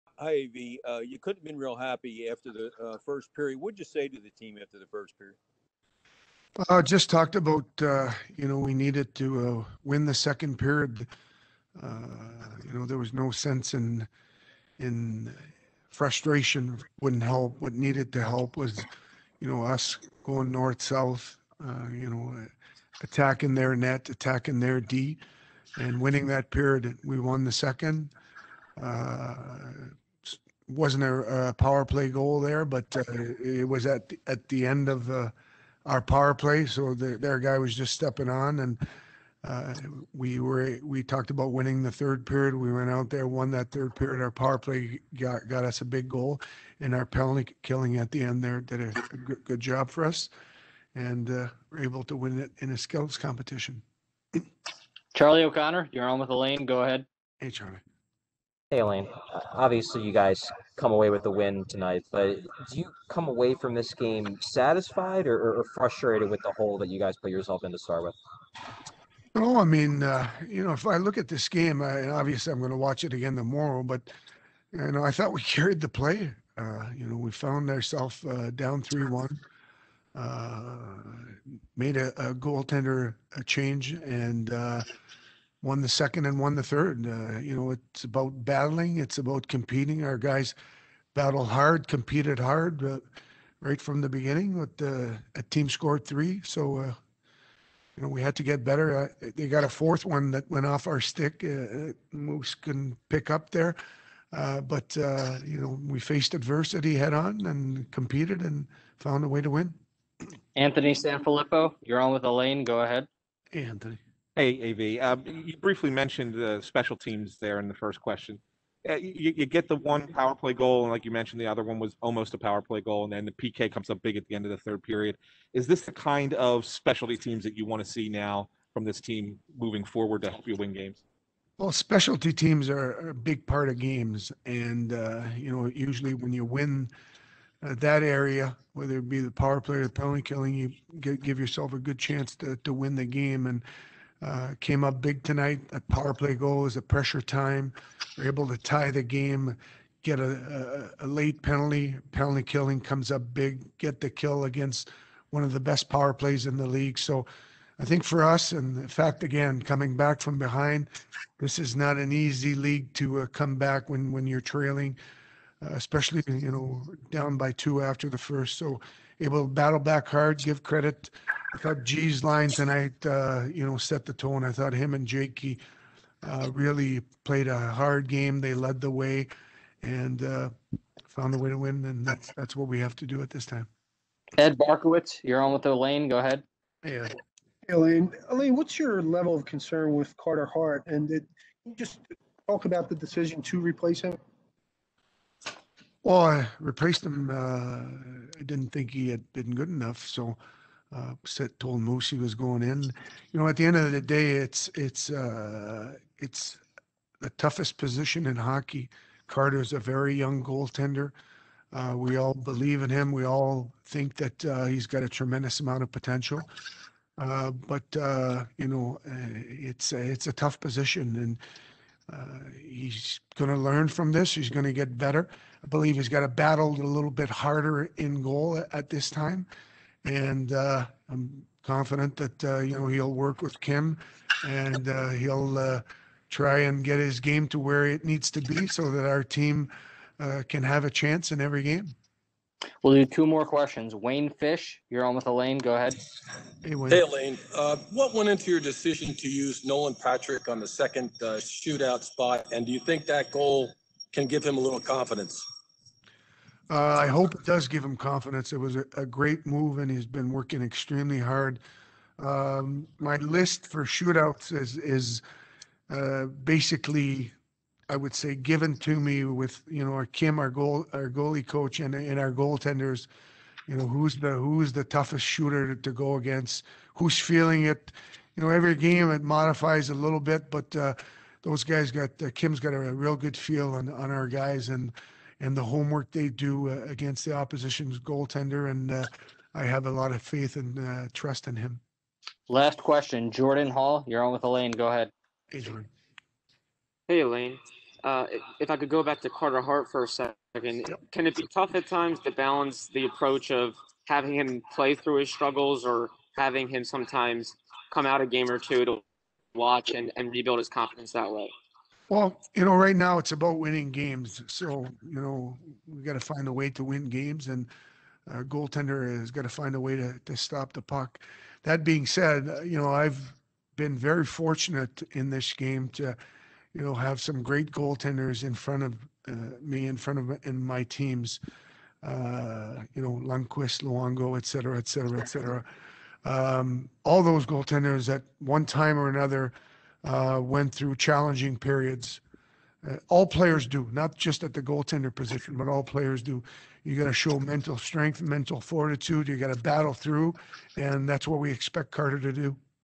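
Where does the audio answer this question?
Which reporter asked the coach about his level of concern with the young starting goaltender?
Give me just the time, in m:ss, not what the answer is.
3:04.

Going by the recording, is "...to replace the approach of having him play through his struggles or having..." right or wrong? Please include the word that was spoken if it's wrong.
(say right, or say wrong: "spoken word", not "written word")
wrong: "balance", not "replace".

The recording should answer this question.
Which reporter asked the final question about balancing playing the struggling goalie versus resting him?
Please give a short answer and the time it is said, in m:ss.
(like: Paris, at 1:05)
Jordan Hall, at 4:53.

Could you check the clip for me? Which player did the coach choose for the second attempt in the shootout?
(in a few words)
Nolan Patrick.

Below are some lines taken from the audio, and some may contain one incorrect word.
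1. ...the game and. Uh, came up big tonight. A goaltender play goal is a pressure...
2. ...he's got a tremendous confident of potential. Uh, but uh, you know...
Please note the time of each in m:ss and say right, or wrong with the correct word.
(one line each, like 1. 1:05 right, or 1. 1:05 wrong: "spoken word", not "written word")
1. 2:22 wrong: "power", not "goaltender"
2. 3:34 wrong: "amount", not "confident".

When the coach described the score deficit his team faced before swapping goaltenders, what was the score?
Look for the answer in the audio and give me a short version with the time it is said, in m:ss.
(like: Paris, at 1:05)
3-1, at 1:18.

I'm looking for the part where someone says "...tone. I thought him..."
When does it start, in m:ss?
2:54.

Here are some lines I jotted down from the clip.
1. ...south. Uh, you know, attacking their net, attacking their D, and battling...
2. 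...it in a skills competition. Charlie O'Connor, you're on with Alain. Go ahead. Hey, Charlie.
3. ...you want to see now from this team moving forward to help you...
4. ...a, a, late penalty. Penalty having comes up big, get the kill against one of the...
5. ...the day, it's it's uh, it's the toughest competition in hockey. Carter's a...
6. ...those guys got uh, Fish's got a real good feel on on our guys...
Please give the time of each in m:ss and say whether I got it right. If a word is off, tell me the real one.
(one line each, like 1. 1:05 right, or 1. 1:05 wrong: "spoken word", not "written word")
1. 0:20 wrong: "winning", not "battling"
2. 0:52 right
3. 2:07 right
4. 2:31 wrong: "killing", not "having"
5. 3:23 wrong: "position", not "competition"
6. 4:41 wrong: "Kim", not "Fish".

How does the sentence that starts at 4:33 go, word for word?
You know who's the who's the toughest shooter to go against?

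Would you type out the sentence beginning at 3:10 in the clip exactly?
And did you just talk about the decision to replace him?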